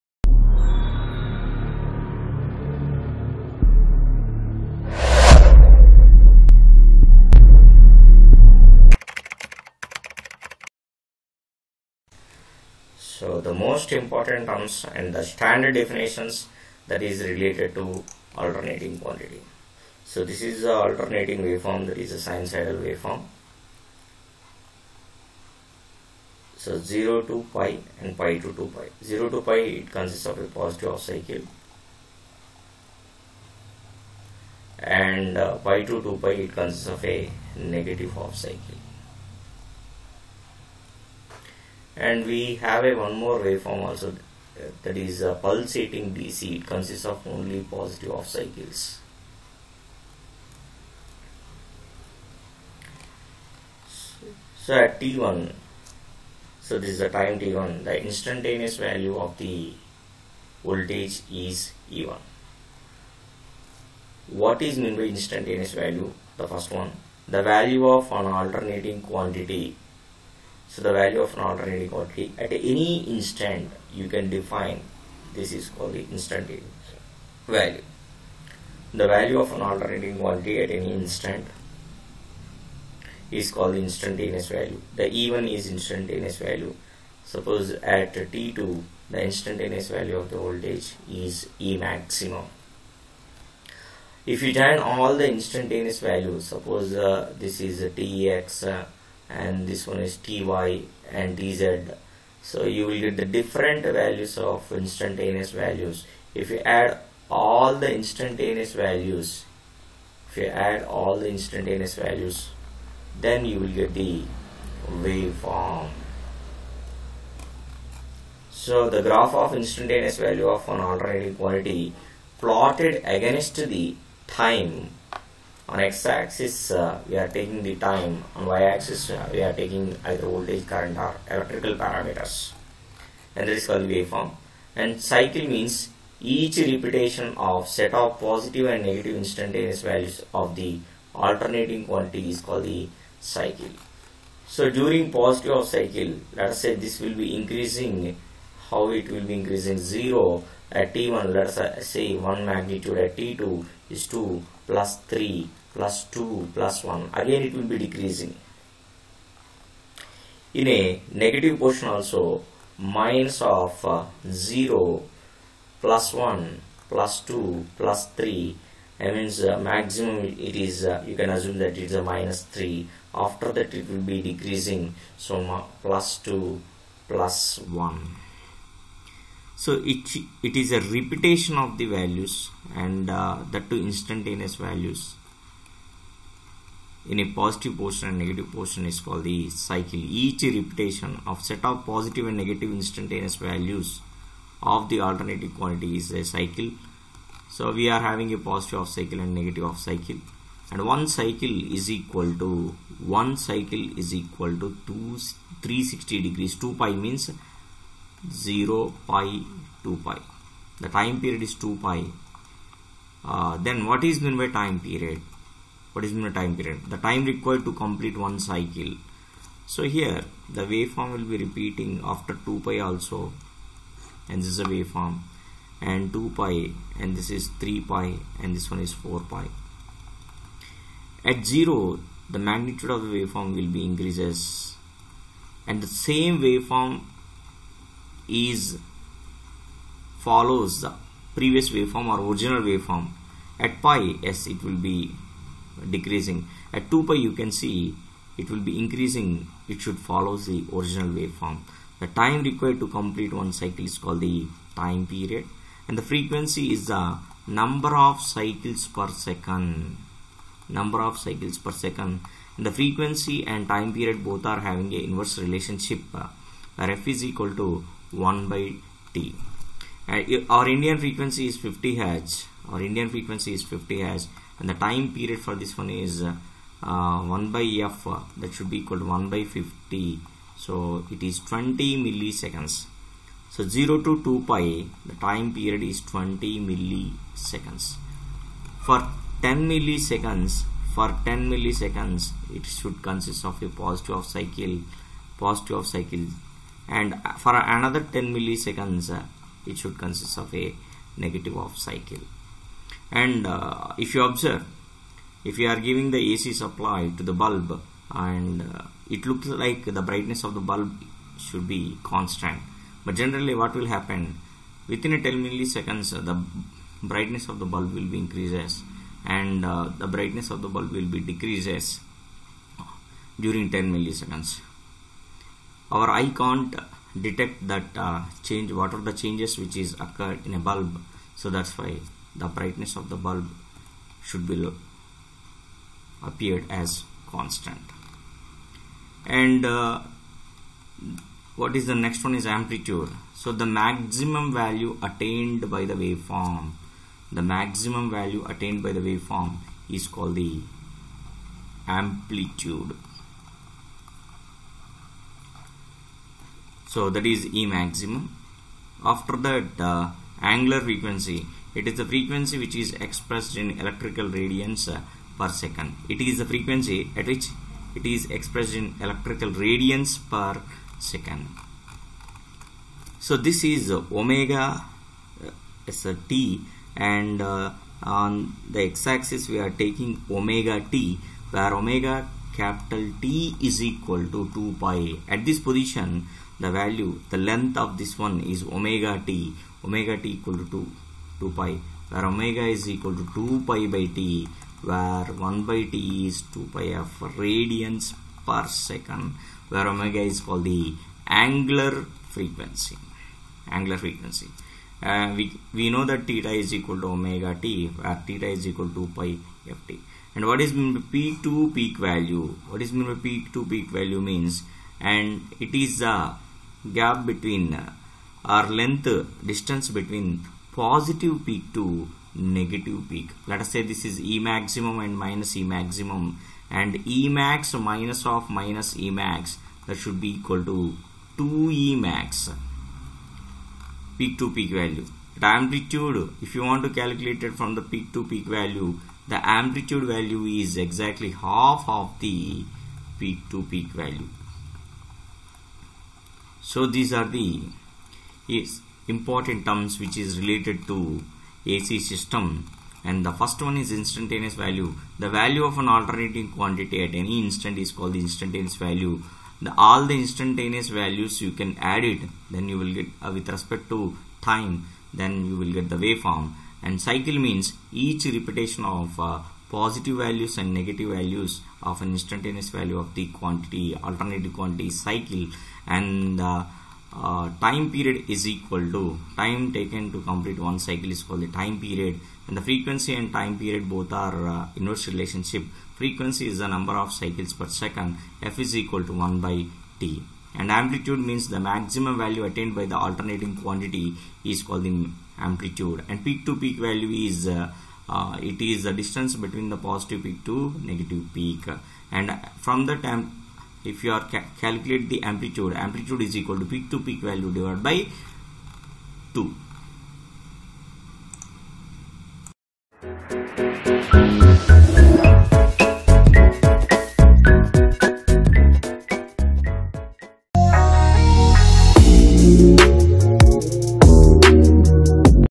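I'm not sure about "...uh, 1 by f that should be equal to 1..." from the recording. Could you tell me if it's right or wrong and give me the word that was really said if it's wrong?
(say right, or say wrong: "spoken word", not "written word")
right.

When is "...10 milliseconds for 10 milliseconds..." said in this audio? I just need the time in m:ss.
4:49.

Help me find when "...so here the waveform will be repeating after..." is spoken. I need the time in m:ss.
3:39.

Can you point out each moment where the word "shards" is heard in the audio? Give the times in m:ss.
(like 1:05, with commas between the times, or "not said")
not said.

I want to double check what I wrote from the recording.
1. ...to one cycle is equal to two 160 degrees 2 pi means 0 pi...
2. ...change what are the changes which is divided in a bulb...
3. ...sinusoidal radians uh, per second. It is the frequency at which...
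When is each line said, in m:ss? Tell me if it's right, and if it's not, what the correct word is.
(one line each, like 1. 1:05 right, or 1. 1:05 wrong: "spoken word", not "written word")
1. 3:22 wrong: "360", not "160"
2. 5:28 wrong: "occurred", not "divided"
3. 6:03 wrong: "electrical", not "sinusoidal".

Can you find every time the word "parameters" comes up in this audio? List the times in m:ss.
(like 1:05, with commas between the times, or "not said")
2:11.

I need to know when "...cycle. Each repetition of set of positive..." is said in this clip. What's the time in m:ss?
3:09.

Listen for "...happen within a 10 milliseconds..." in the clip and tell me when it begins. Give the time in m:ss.
5:13.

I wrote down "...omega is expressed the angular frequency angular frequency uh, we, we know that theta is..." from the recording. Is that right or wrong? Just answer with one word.
wrong.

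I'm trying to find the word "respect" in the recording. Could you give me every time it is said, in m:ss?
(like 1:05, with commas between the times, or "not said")
7:43.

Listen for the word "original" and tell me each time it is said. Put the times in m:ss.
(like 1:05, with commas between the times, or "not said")
4:02, 4:10.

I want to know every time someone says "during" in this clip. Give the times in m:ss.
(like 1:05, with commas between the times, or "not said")
2:24, 5:23.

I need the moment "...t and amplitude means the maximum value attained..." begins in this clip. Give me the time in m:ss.
8:09.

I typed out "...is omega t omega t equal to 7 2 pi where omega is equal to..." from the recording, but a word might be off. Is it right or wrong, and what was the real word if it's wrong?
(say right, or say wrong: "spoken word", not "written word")
wrong: "2", not "7".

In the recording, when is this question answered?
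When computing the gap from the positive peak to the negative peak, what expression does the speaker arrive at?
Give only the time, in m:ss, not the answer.
7:11.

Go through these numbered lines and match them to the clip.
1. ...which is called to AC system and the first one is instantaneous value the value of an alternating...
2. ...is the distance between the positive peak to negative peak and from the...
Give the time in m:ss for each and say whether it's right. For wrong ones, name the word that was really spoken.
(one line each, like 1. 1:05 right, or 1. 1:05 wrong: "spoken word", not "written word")
1. 7:30 wrong: "related", not "called"
2. 8:18 right.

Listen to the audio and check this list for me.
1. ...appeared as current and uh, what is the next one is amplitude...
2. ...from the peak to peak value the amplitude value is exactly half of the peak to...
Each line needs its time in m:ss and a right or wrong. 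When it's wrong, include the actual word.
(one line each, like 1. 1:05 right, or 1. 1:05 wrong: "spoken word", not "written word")
1. 5:36 wrong: "constant", not "current"
2. 7:17 right.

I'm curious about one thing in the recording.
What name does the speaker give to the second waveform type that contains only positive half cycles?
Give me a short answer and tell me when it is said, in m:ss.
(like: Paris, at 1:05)
pulsating DC, at 0:45.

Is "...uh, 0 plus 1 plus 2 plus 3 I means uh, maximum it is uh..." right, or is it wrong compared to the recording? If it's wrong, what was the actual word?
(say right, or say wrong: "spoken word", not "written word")
right.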